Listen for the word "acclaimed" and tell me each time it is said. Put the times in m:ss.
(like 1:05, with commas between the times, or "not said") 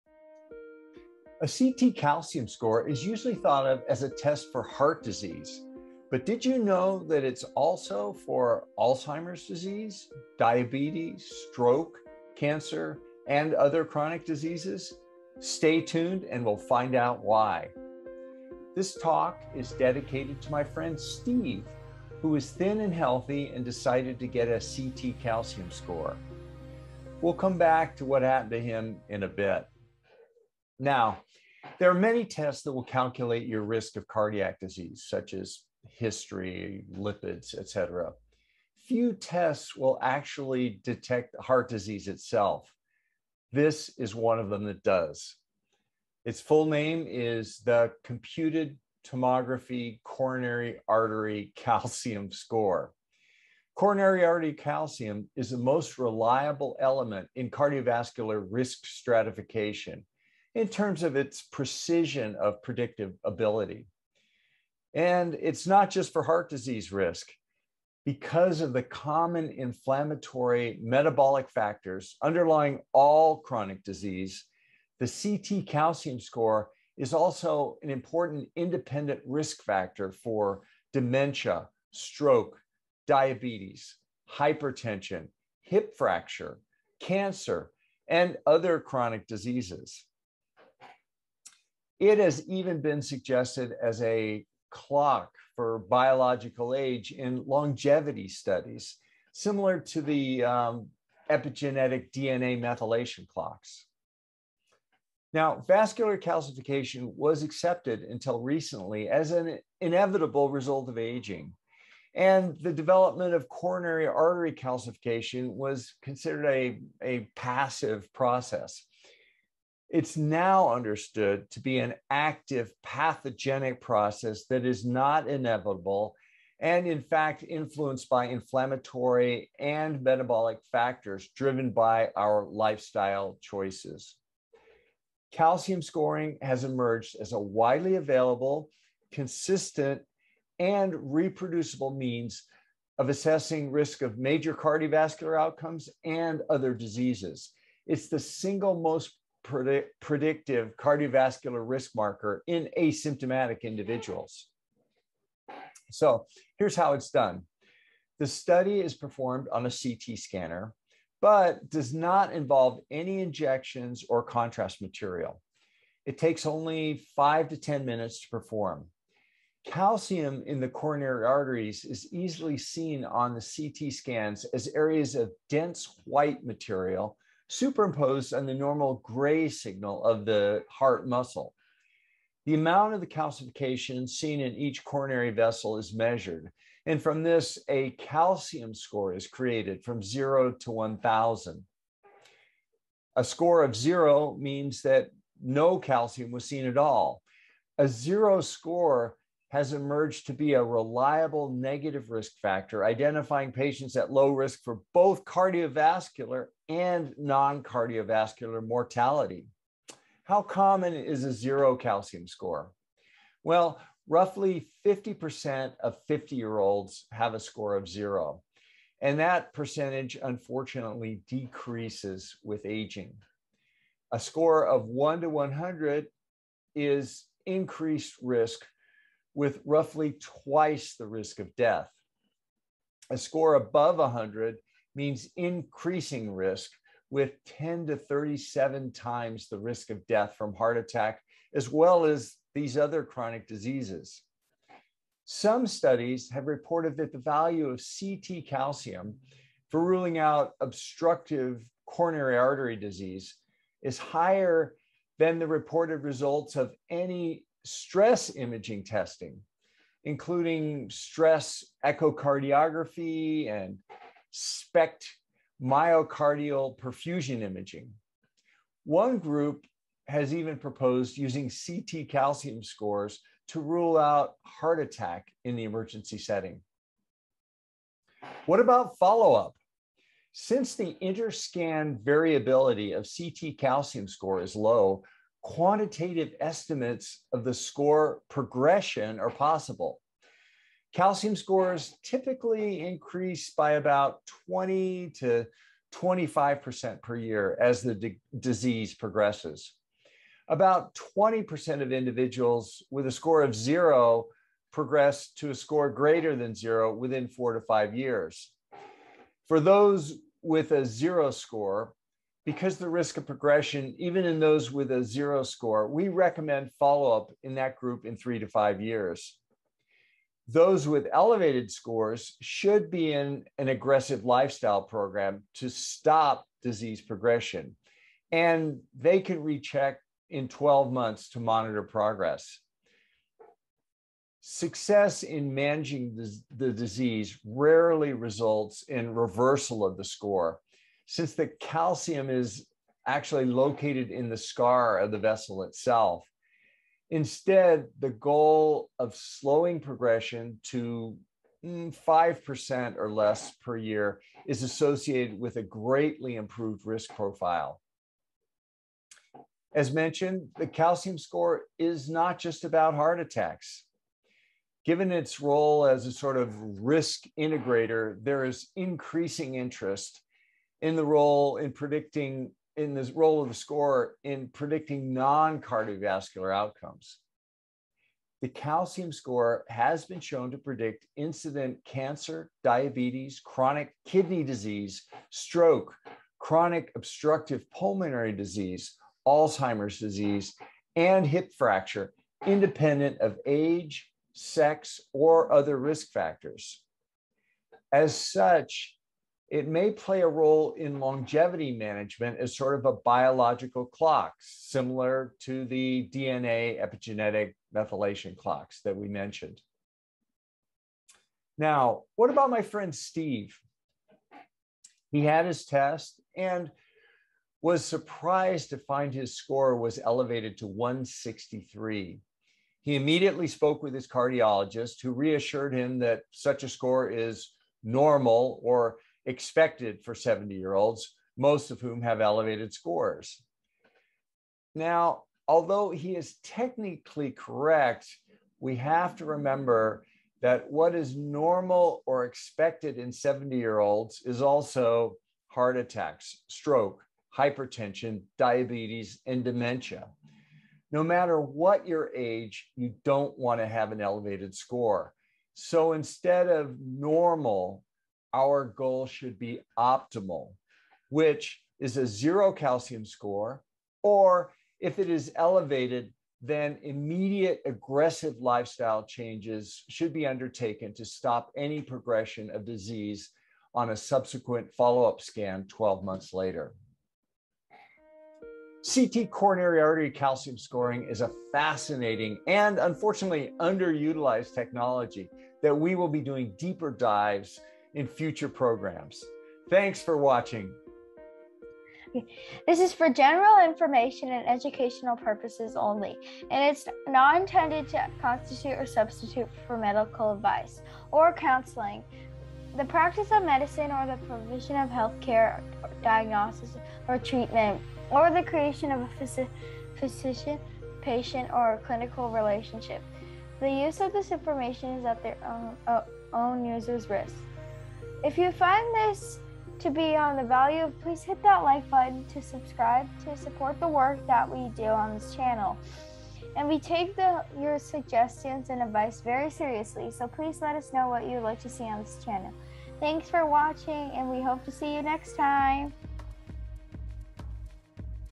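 not said.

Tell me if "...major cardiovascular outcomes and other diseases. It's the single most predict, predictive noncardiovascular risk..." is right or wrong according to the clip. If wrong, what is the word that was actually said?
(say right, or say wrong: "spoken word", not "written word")
wrong: "cardiovascular", not "noncardiovascular".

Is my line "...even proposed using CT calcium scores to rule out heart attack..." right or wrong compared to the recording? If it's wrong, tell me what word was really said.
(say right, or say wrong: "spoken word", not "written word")
right.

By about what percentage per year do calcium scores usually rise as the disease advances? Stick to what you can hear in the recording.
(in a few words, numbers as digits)
20 to 25%.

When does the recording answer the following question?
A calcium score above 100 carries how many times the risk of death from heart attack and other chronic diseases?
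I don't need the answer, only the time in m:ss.
3:57.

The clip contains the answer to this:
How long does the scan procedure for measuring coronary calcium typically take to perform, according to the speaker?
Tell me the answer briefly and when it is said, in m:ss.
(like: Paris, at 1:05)
5 to 10 minutes, at 2:47.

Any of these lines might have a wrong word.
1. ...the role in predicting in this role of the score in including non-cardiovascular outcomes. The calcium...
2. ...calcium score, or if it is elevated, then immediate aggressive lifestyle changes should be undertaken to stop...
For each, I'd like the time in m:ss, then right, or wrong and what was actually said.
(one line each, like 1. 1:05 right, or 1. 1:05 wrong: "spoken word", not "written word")
1. 6:10 wrong: "predicting", not "including"
2. 7:42 right.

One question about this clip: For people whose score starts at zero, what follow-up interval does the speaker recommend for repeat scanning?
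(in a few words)
3 to 5 years.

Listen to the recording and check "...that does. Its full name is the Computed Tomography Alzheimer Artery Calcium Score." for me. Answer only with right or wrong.
wrong.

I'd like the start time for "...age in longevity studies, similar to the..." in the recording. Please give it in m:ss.
1:36.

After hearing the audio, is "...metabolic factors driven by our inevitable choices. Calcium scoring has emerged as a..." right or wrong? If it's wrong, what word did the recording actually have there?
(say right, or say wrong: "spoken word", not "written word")
wrong: "lifestyle", not "inevitable".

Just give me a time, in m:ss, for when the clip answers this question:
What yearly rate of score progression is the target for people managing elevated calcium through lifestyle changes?
5:51.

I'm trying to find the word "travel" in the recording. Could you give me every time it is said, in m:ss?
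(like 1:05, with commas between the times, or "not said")
not said.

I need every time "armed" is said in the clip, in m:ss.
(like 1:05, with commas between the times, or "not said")
not said.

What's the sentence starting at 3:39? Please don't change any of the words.
And that percentage, unfortunately, decreases with aging.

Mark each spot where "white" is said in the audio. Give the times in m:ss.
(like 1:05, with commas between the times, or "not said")
2:56.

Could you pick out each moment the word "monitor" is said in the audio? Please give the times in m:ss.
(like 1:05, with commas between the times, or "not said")
5:31.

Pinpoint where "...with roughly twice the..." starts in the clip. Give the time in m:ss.
3:49.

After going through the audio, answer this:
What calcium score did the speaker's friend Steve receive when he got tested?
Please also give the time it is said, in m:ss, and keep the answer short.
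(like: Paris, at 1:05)
163, at 7:00.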